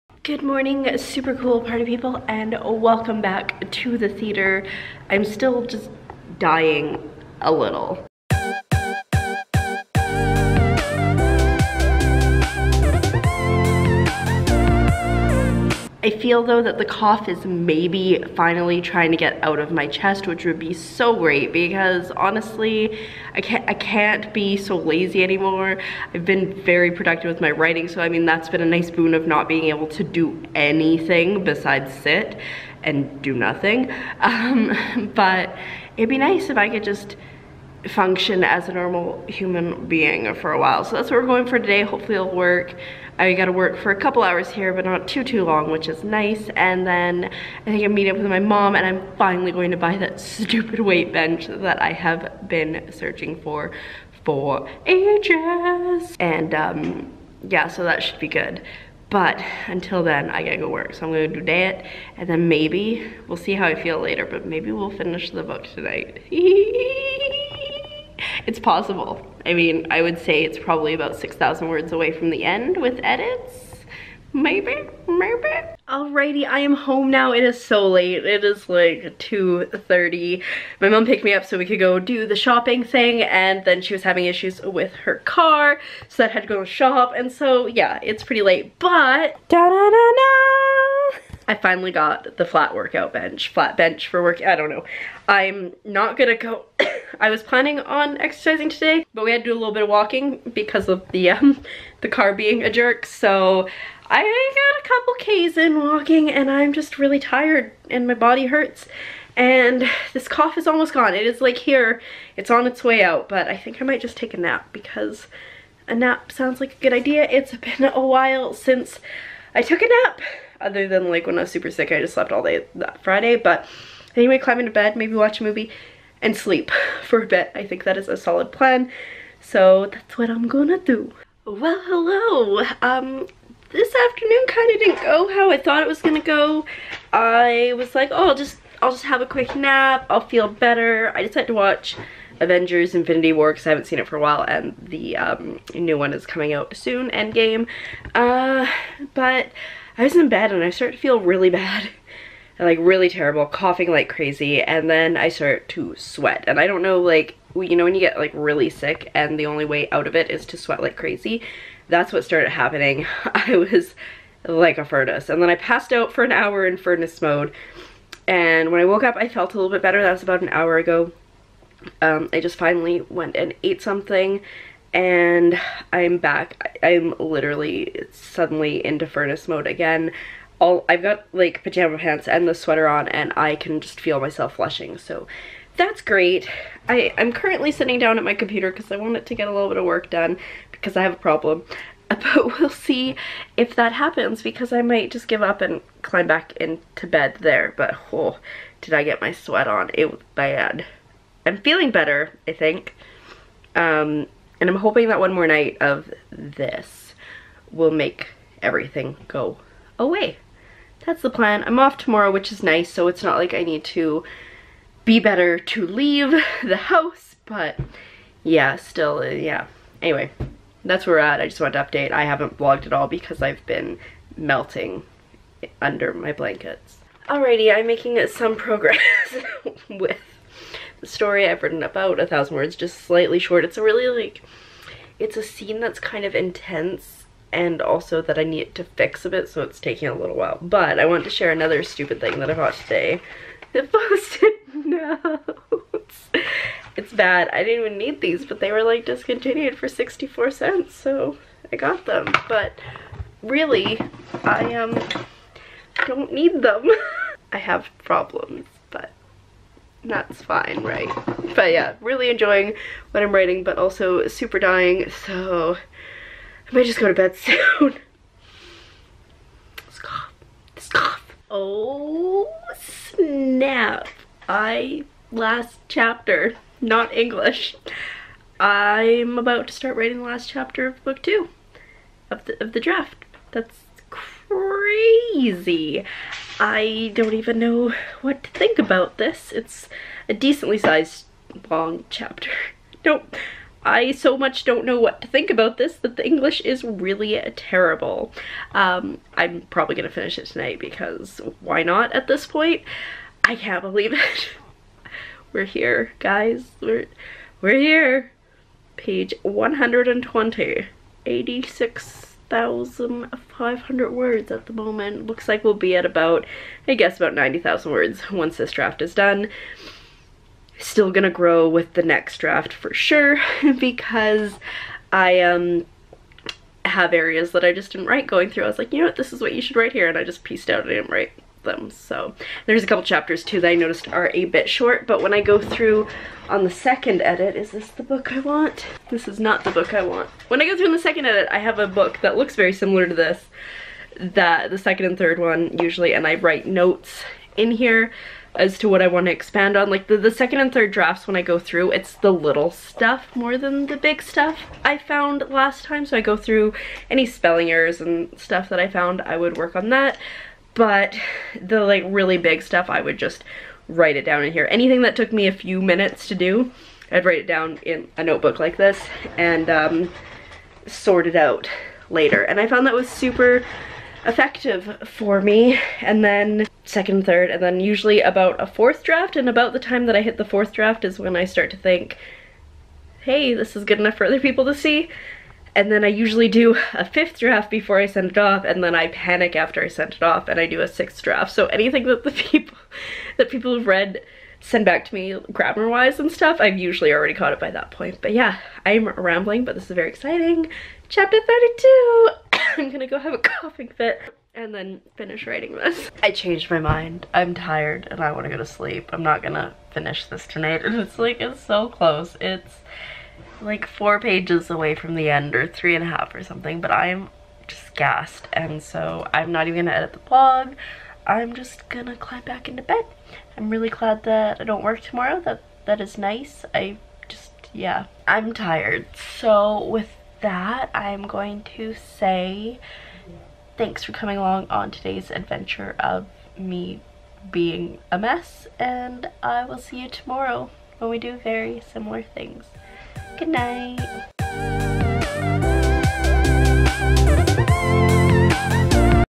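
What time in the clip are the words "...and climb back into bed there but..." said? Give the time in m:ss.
3:15.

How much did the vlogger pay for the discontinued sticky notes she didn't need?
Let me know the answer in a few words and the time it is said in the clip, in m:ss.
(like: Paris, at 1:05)
64 cents, at 4:09.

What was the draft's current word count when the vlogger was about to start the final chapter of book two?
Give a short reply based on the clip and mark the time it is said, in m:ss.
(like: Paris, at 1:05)
86,500, at 5:11.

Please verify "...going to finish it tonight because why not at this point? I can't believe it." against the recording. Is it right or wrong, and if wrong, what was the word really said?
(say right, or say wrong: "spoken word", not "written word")
right.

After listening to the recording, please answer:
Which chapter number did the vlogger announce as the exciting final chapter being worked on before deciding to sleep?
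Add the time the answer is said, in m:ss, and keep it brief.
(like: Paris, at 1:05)
32, at 6:41.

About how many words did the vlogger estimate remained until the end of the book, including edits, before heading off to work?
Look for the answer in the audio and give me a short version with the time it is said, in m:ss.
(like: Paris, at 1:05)
6,000, at 1:11.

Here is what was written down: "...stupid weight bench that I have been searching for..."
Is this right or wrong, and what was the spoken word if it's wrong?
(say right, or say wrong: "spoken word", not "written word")
right.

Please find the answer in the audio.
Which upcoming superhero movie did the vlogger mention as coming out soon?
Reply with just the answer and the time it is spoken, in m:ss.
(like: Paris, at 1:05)
Endgame, at 2:27.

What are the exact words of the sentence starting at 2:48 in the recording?
And when I woke up, I felt a little bit better.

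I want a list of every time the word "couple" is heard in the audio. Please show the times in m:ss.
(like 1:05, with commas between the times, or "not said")
0:43, 1:44, 5:32.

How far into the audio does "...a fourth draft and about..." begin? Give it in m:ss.
6:18.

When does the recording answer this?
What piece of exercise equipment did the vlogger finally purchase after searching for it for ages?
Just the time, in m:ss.
1:32.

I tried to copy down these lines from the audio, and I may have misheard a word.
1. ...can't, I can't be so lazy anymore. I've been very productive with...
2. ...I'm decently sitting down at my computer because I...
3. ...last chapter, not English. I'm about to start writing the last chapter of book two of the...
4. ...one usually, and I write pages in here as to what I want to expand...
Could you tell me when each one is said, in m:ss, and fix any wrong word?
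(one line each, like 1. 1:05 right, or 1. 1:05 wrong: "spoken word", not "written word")
1. 0:23 right
2. 3:07 wrong: "currently", not "decently"
3. 4:35 right
4. 5:45 wrong: "notes", not "pages".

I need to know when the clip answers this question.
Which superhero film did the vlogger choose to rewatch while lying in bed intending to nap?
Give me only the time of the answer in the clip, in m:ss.
2:22.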